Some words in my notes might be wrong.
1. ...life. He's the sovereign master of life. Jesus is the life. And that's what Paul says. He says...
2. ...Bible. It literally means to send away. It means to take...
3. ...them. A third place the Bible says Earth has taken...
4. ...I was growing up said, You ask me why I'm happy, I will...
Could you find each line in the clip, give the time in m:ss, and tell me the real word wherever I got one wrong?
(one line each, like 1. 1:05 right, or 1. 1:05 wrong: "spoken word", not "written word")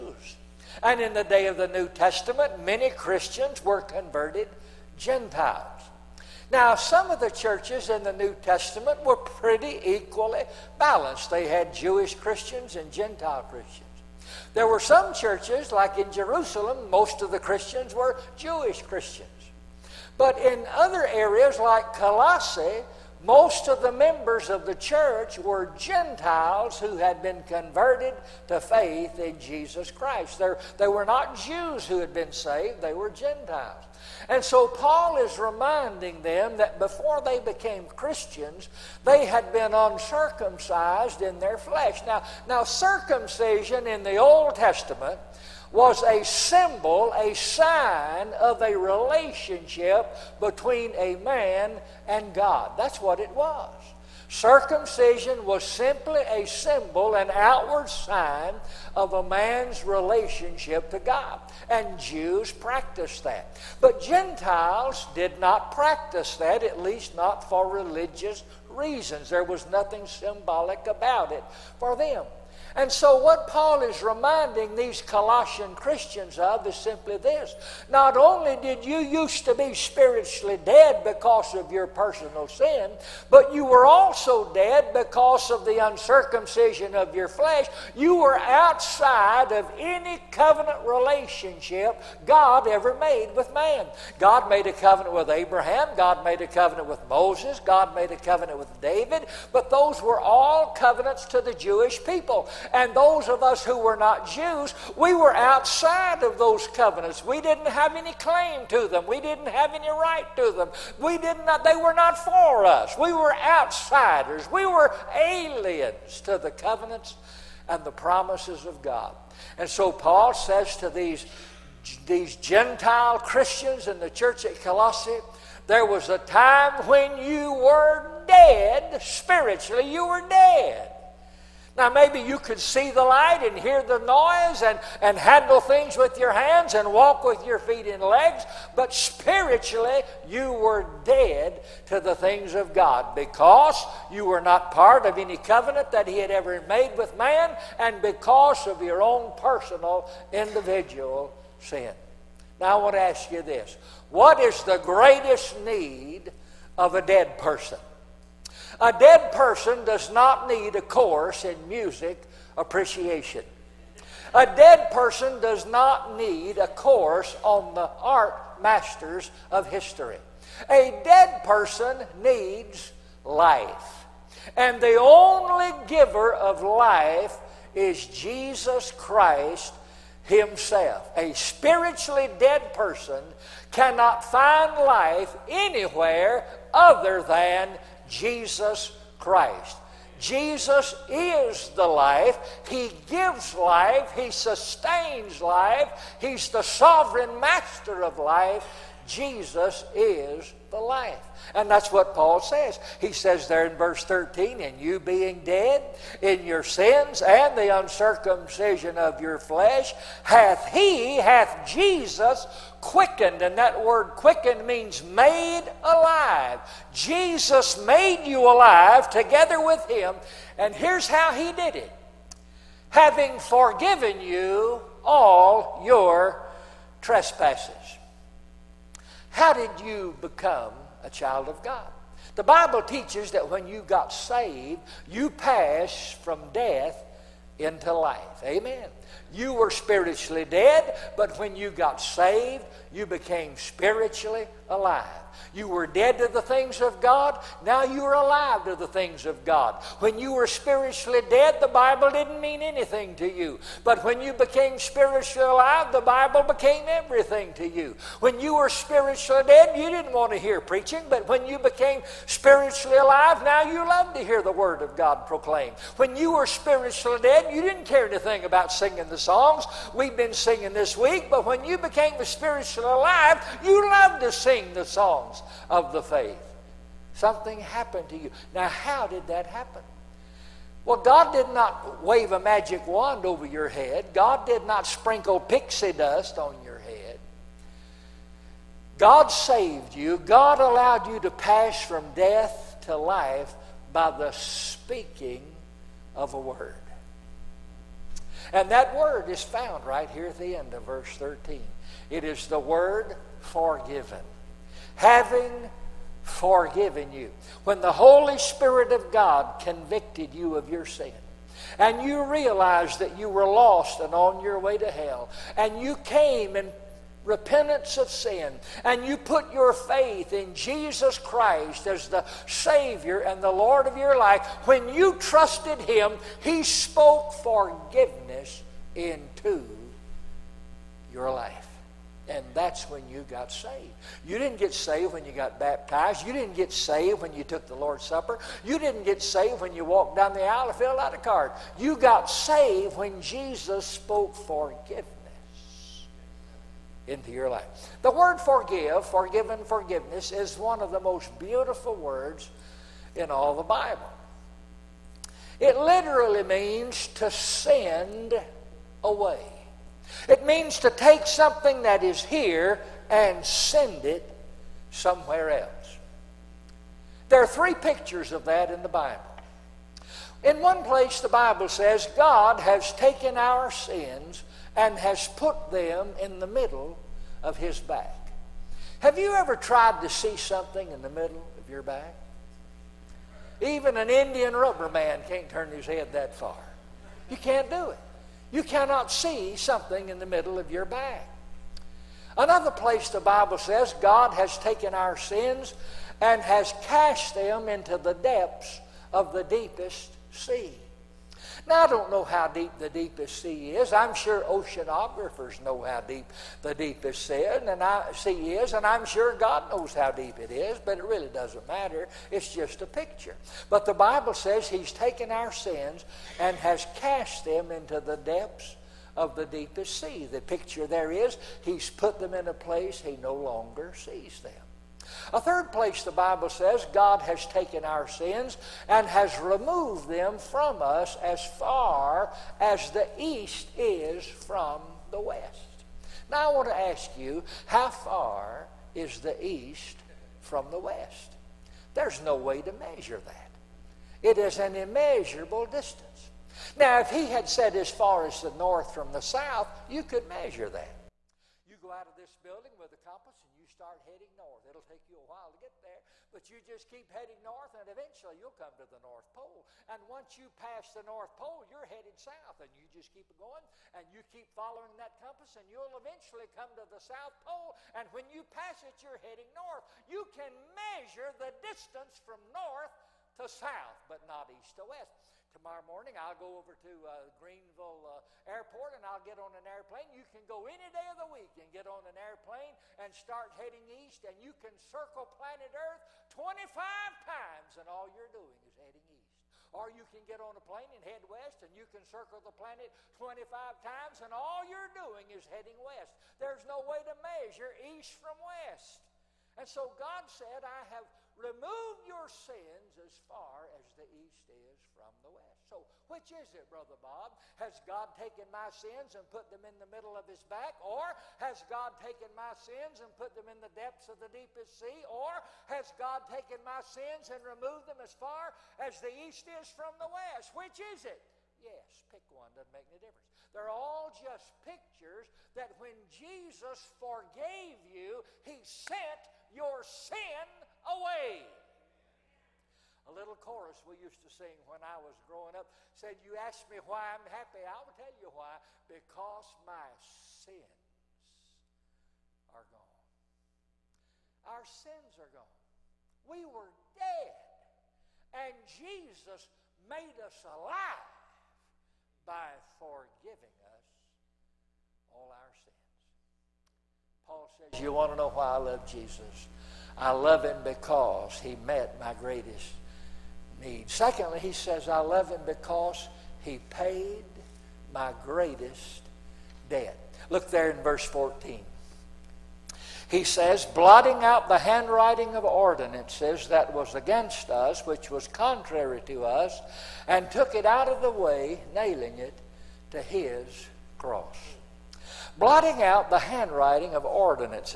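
1. 3:15 right
2. 5:53 right
3. 7:04 wrong: "God", not "Earth"
4. 8:54 right.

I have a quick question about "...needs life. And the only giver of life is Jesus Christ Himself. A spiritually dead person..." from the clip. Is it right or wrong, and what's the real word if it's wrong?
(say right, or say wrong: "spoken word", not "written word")
right.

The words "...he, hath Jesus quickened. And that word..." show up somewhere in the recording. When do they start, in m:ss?
3:30.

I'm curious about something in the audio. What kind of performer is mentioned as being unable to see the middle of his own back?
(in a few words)
Indian rubber man.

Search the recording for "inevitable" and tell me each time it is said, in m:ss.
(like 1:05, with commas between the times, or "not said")
not said.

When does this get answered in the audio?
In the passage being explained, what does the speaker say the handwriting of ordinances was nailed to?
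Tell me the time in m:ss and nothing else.
9:43.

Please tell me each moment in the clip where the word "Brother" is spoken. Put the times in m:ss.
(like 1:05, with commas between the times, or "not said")
8:26.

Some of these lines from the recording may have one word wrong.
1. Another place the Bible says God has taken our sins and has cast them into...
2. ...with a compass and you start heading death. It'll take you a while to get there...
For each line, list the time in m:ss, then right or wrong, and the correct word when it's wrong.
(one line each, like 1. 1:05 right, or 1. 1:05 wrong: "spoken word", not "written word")
1. 6:32 right
2. 7:32 wrong: "north", not "death".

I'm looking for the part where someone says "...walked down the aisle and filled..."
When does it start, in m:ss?
5:39.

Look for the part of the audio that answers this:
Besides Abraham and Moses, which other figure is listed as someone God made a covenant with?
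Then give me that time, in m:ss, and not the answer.
1:38.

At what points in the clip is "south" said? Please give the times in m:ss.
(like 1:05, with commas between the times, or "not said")
7:29, 7:42, 7:46, 7:53.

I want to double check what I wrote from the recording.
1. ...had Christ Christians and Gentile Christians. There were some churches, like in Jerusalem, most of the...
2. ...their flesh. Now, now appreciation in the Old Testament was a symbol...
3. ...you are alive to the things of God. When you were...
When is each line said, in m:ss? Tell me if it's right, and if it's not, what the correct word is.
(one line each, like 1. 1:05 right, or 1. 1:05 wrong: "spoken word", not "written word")
1. 0:11 wrong: "Jewish", not "Christ"
2. 0:41 wrong: "circumcision", not "appreciation"
3. 4:07 right.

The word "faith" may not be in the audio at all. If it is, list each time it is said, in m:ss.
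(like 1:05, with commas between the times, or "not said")
0:28, 4:36, 5:19.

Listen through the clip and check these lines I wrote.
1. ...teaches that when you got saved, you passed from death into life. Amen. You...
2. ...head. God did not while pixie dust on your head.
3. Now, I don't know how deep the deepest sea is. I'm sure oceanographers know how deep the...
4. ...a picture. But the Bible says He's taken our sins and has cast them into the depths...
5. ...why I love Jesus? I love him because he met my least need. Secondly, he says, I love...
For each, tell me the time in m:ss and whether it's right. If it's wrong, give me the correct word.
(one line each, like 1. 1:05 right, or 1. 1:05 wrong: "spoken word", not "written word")
1. 3:52 right
2. 4:43 wrong: "sprinkle", not "while"
3. 6:41 right
4. 6:52 right
5. 9:18 wrong: "greatest", not "least".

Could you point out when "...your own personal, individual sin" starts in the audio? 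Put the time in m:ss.
2:28.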